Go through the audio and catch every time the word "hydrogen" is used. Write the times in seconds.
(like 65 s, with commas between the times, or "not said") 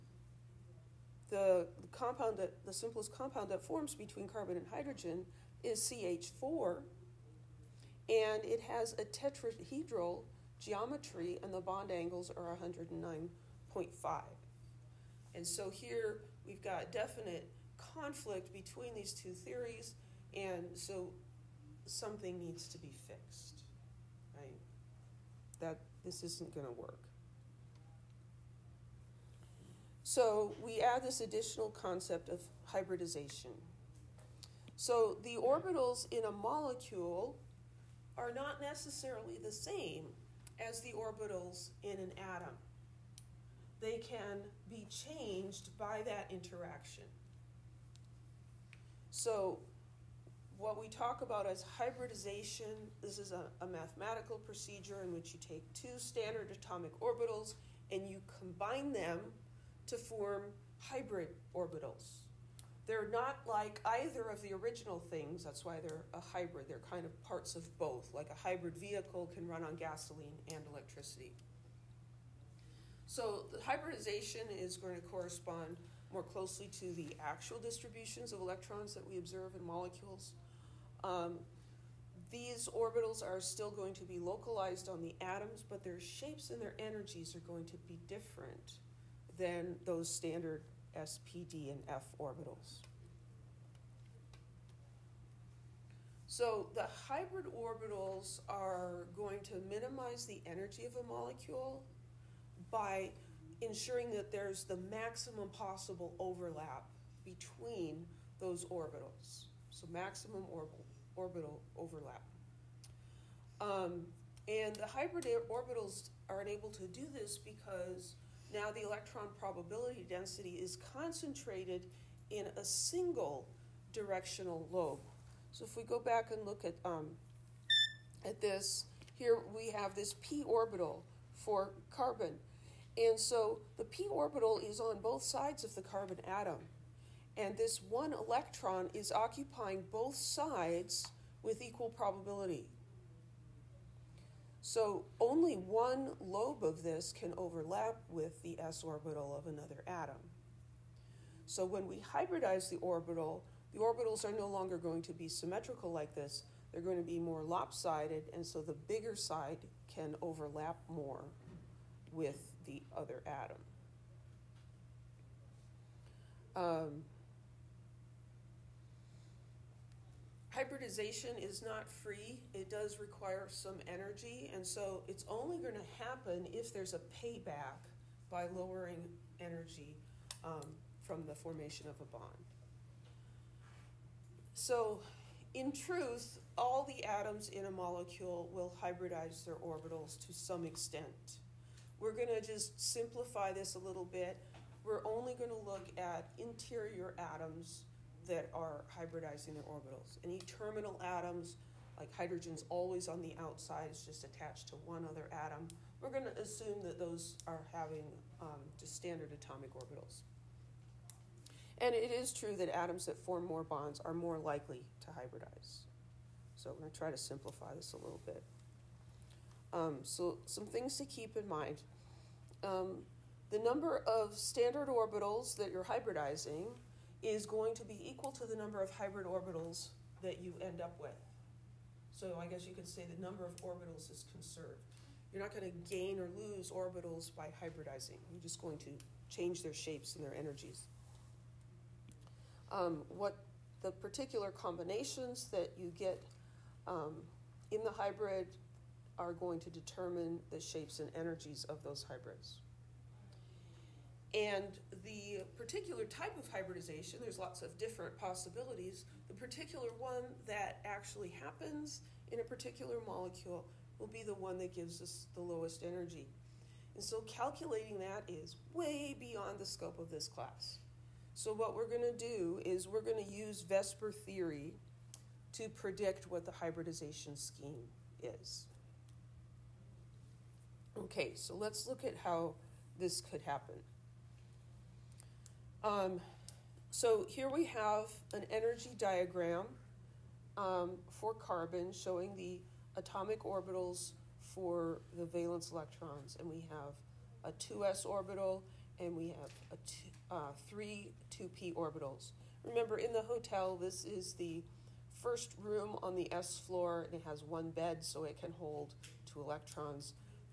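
4 s, 202 s.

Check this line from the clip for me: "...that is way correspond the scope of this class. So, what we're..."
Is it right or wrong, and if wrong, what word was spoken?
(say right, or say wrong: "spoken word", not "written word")
wrong: "beyond", not "correspond".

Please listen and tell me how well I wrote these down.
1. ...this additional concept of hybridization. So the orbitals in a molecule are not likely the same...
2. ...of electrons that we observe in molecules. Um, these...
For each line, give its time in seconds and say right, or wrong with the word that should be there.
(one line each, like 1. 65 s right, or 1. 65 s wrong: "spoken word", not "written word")
1. 31 s wrong: "necessarily", not "likely"
2. 78 s right.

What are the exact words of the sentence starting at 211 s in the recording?
And it is true that atoms that form more bonds are more likely to hybridize.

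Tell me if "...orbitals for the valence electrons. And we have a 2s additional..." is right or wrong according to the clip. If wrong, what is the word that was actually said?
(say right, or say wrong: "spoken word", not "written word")
wrong: "orbital", not "additional".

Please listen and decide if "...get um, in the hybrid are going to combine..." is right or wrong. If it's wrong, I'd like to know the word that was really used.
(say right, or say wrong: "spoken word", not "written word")
wrong: "determine", not "combine".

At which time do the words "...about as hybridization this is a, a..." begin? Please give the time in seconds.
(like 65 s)
51 s.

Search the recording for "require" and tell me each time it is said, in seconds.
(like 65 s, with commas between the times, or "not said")
173 s.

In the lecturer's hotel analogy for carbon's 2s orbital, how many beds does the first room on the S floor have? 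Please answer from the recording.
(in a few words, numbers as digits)
1.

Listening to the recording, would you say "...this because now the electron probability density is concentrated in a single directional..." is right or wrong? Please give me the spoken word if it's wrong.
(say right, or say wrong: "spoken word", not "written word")
right.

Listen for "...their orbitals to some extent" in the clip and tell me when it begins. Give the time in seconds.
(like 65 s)
189 s.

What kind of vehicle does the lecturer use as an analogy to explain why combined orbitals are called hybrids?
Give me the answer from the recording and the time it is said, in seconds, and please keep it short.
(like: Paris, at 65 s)
hybrid vehicle, at 68 s.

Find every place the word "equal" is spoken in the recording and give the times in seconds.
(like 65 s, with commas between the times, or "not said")
141 s, 228 s.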